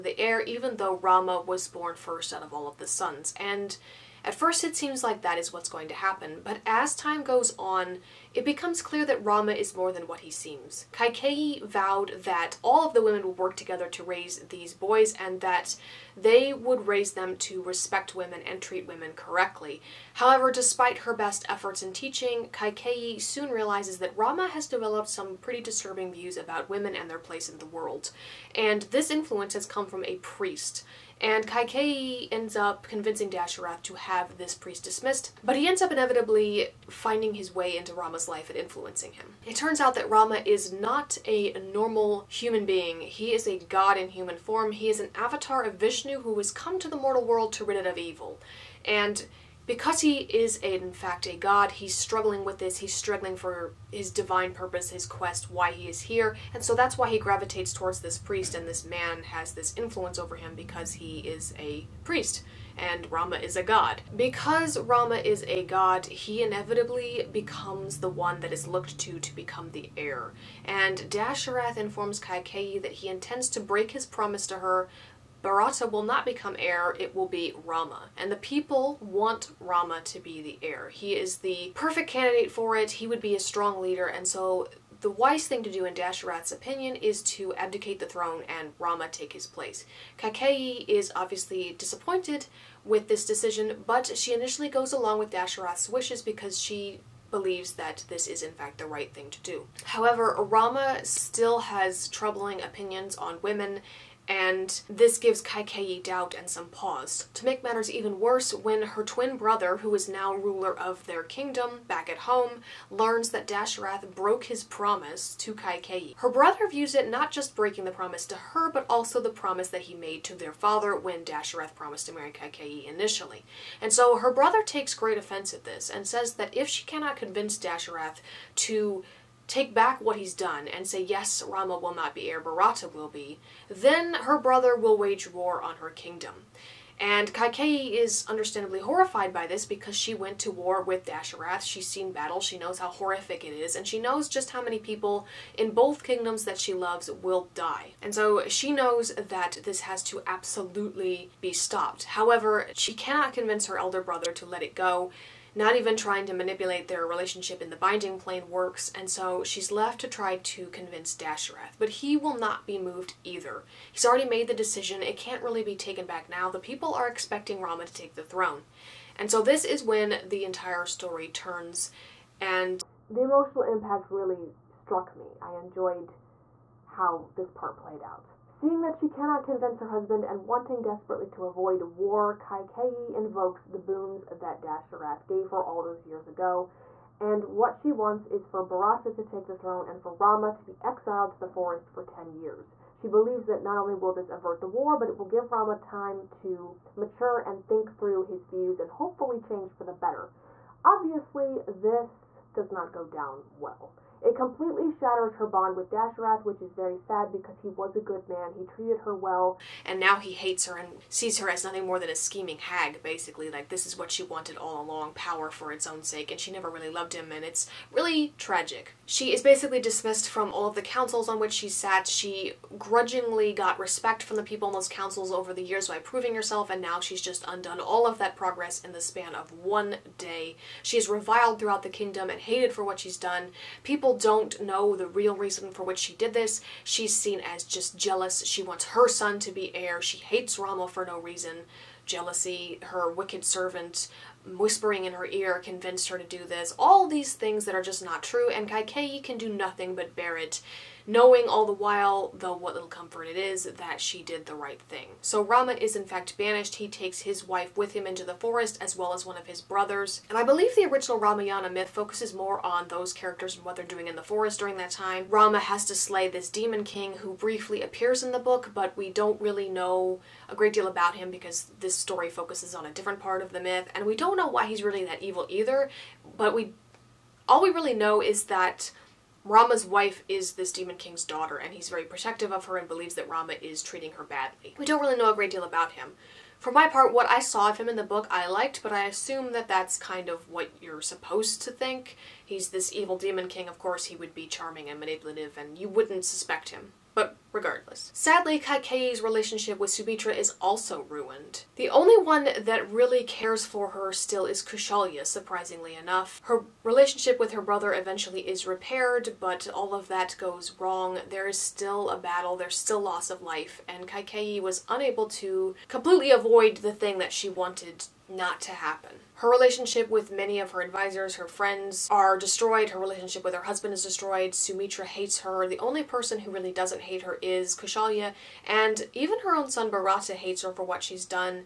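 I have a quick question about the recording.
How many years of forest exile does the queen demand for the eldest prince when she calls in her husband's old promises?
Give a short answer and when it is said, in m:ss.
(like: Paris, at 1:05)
10, at 3:12.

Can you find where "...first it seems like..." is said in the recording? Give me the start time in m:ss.
0:04.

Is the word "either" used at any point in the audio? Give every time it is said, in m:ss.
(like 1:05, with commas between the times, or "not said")
2:43, 4:35.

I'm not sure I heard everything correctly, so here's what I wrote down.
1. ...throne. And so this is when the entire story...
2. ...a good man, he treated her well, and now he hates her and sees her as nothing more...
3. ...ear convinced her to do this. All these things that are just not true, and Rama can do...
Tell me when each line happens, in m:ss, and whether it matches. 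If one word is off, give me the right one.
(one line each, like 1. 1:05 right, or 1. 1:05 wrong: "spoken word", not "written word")
1. 2:48 right
2. 3:27 right
3. 4:05 wrong: "Kaikeyi", not "Rama".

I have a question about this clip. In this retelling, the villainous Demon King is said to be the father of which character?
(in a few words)
Rama's wife.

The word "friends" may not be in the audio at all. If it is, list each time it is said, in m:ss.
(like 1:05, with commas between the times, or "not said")
5:21.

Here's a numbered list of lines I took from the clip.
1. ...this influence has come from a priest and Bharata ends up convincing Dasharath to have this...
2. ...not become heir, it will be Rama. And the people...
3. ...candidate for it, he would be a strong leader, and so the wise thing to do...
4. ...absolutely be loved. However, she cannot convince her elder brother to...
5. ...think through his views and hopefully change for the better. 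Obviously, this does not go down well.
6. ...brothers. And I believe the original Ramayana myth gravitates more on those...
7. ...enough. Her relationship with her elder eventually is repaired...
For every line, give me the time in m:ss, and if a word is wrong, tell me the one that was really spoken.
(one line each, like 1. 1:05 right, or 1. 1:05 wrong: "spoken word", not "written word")
1. 0:28 wrong: "Kaikei", not "Bharata"
2. 1:16 right
3. 1:22 right
4. 2:30 wrong: "stopped", not "loved"
5. 3:17 right
6. 4:19 wrong: "focuses", not "gravitates"
7. 5:05 wrong: "brother", not "elder".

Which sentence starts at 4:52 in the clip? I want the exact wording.
He's this evil Demon King, of course he would be charming and manipulative, and you wouldn't suspect him.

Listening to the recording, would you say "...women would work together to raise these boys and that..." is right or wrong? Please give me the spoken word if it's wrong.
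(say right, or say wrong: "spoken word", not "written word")
right.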